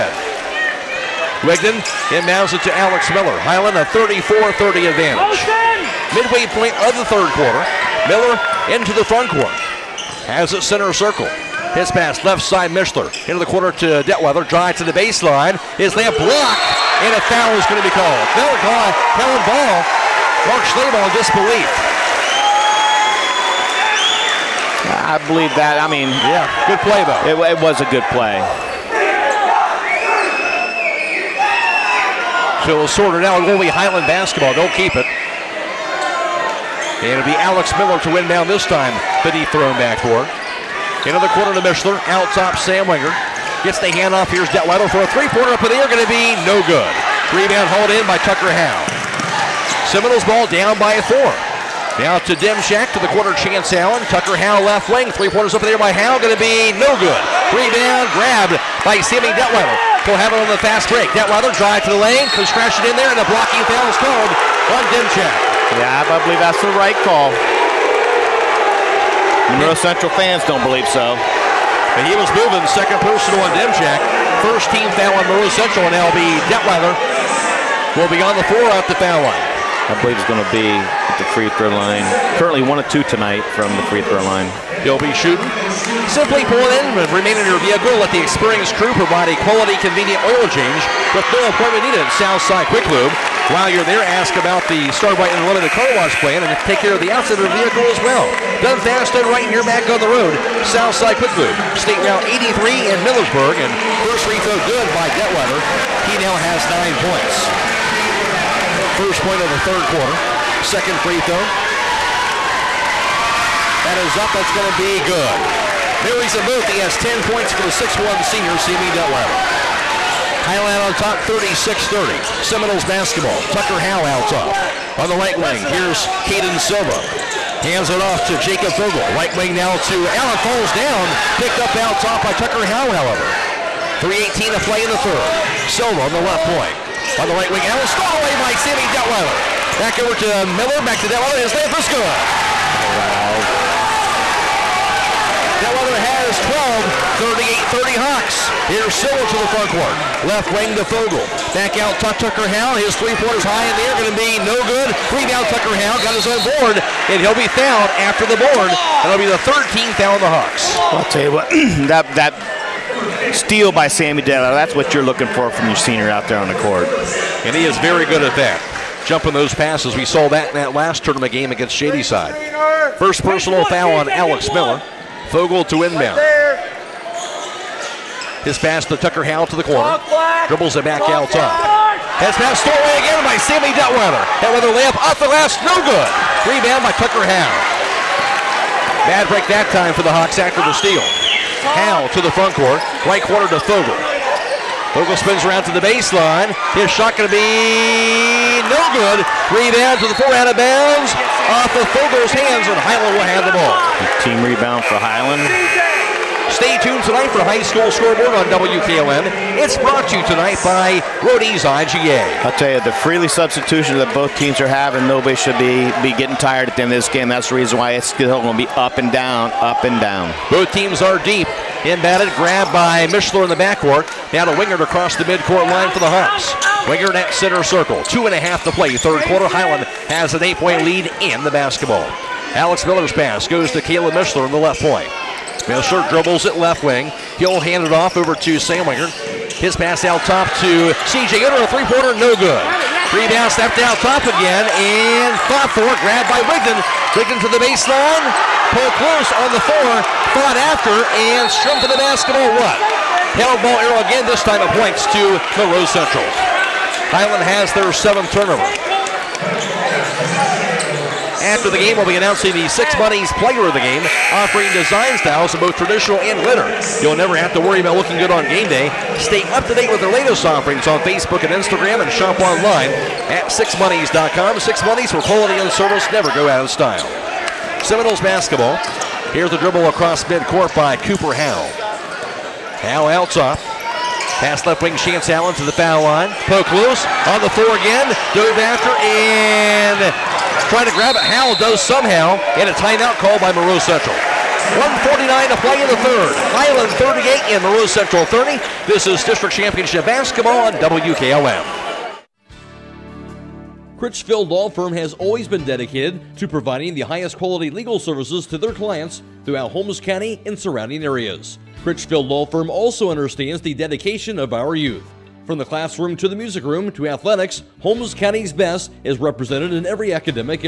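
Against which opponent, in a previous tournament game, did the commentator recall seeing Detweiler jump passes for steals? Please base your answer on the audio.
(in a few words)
Shadyside.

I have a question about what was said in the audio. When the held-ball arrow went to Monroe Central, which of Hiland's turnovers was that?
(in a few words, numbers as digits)
7th.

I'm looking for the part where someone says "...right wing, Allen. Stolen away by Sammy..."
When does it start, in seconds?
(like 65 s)
137 s.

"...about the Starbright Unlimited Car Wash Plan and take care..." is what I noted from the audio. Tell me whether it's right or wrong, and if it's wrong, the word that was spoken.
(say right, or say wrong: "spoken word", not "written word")
right.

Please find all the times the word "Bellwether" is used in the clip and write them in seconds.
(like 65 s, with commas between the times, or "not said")
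145 s.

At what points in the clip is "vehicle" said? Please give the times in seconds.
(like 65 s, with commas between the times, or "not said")
87 s, 97 s.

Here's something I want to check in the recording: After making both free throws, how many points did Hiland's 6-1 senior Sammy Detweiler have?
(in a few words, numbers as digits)
10.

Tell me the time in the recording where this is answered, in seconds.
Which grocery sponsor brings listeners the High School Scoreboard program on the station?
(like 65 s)
211 s.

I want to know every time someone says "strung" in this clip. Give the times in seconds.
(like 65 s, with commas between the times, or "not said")
251 s.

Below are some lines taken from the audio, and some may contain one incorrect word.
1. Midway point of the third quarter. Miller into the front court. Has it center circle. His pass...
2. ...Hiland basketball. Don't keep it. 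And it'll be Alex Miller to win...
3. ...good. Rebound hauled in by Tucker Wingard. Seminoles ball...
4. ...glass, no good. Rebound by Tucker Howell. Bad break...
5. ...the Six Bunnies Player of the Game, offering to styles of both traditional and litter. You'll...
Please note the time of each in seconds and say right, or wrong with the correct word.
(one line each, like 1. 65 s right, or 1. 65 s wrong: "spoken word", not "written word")
1. 6 s right
2. 33 s right
3. 46 s wrong: "Howe", not "Wingard"
4. 185 s right
5. 262 s right.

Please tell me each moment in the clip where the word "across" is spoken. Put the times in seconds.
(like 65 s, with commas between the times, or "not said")
224 s, 279 s.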